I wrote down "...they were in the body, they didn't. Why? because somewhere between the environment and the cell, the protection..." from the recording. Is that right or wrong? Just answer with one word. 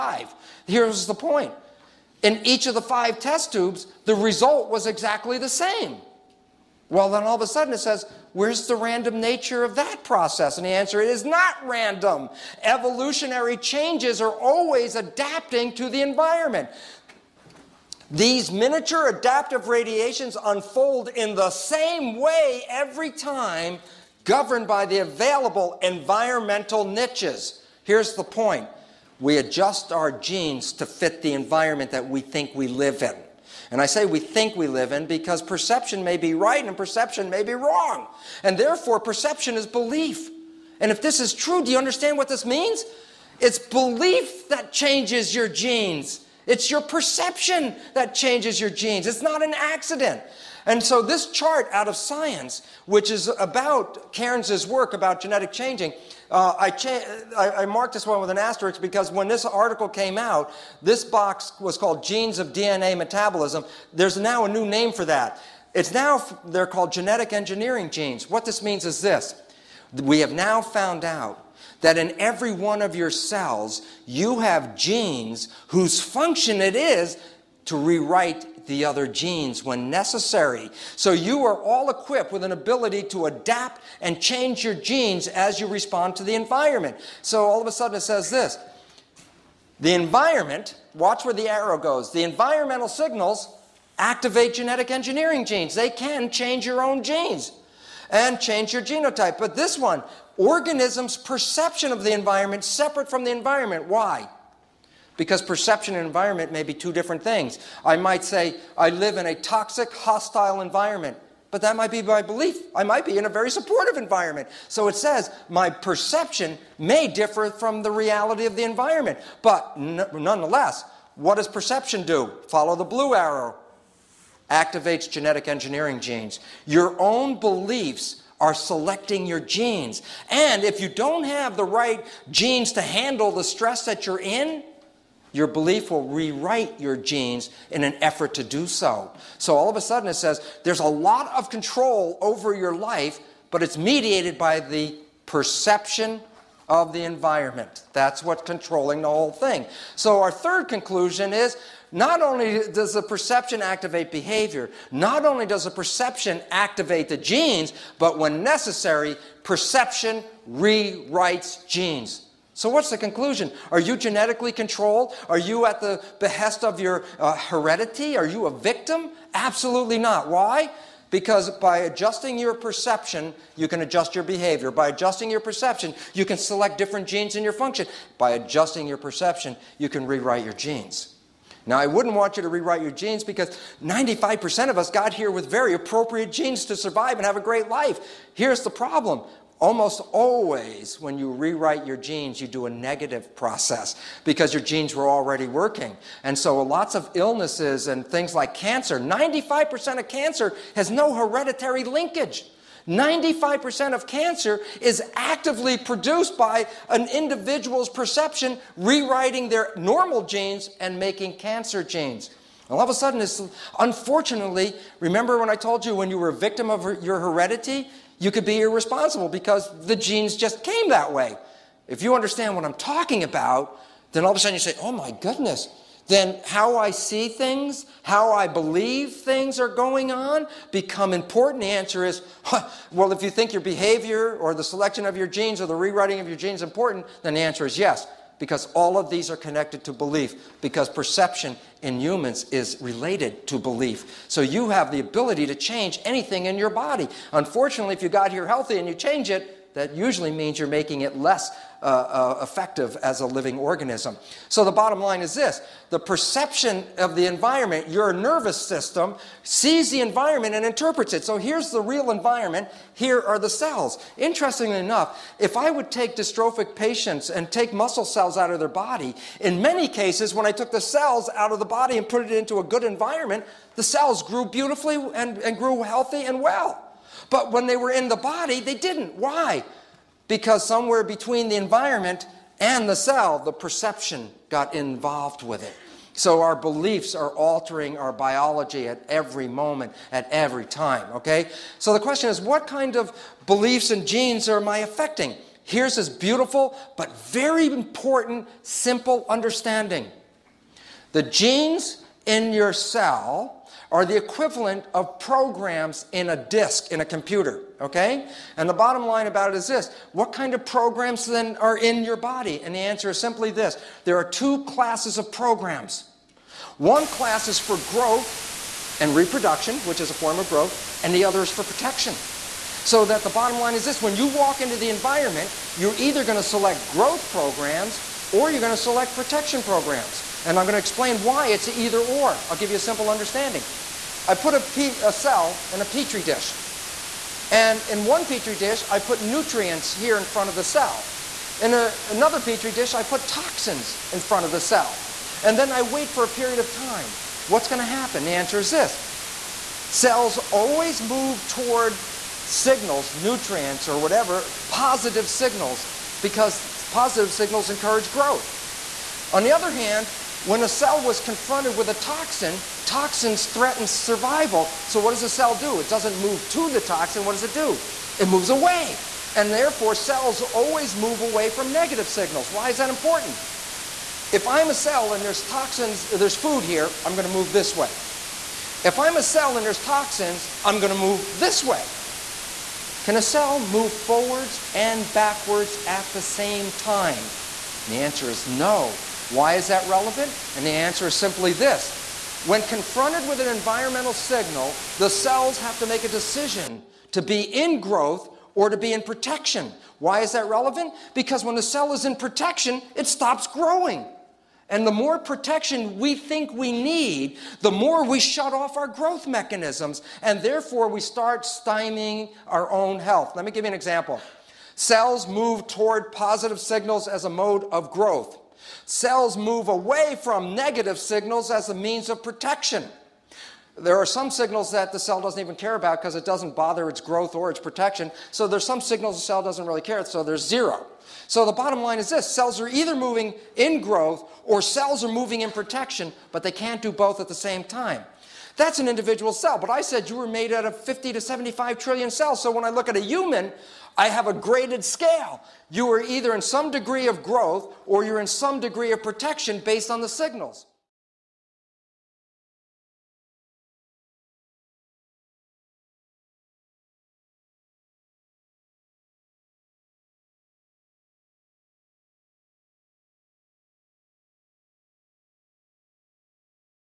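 wrong.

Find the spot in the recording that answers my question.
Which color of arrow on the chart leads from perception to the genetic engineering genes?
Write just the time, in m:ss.
2:02.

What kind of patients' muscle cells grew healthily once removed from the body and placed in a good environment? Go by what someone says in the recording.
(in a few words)
Dystrophic patients.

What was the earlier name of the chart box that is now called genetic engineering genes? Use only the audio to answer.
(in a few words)
Genes of DNA Metabolism.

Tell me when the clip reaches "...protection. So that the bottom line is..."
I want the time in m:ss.
5:21.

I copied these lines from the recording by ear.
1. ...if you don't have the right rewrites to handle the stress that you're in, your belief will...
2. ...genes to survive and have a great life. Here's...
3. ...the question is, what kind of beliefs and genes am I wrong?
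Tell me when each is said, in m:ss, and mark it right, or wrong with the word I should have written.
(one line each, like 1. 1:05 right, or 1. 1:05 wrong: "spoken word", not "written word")
1. 2:10 wrong: "genes", not "rewrites"
2. 3:06 right
3. 4:51 wrong: "affecting", not "wrong".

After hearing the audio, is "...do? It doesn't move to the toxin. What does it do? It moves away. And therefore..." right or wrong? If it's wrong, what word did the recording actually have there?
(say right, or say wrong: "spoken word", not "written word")
right.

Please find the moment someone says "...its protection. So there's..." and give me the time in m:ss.
7:07.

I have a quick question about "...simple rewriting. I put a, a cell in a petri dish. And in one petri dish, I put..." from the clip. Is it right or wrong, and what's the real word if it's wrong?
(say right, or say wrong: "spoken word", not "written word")
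wrong: "understanding", not "rewriting".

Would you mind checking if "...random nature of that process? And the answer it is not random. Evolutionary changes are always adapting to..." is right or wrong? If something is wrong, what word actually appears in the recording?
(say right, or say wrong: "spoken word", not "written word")
right.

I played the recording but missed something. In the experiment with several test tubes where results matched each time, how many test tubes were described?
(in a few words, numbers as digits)
5.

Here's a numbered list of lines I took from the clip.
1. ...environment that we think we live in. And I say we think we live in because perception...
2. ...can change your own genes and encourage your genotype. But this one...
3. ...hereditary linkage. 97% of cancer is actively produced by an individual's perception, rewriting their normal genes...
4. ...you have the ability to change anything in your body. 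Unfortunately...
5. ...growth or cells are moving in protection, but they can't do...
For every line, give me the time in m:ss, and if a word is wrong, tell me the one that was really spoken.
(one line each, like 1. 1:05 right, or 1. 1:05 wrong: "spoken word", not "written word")
1. 0:31 right
2. 1:35 wrong: "change", not "encourage"
3. 3:21 wrong: "95", not "97"
4. 4:04 right
5. 7:13 right.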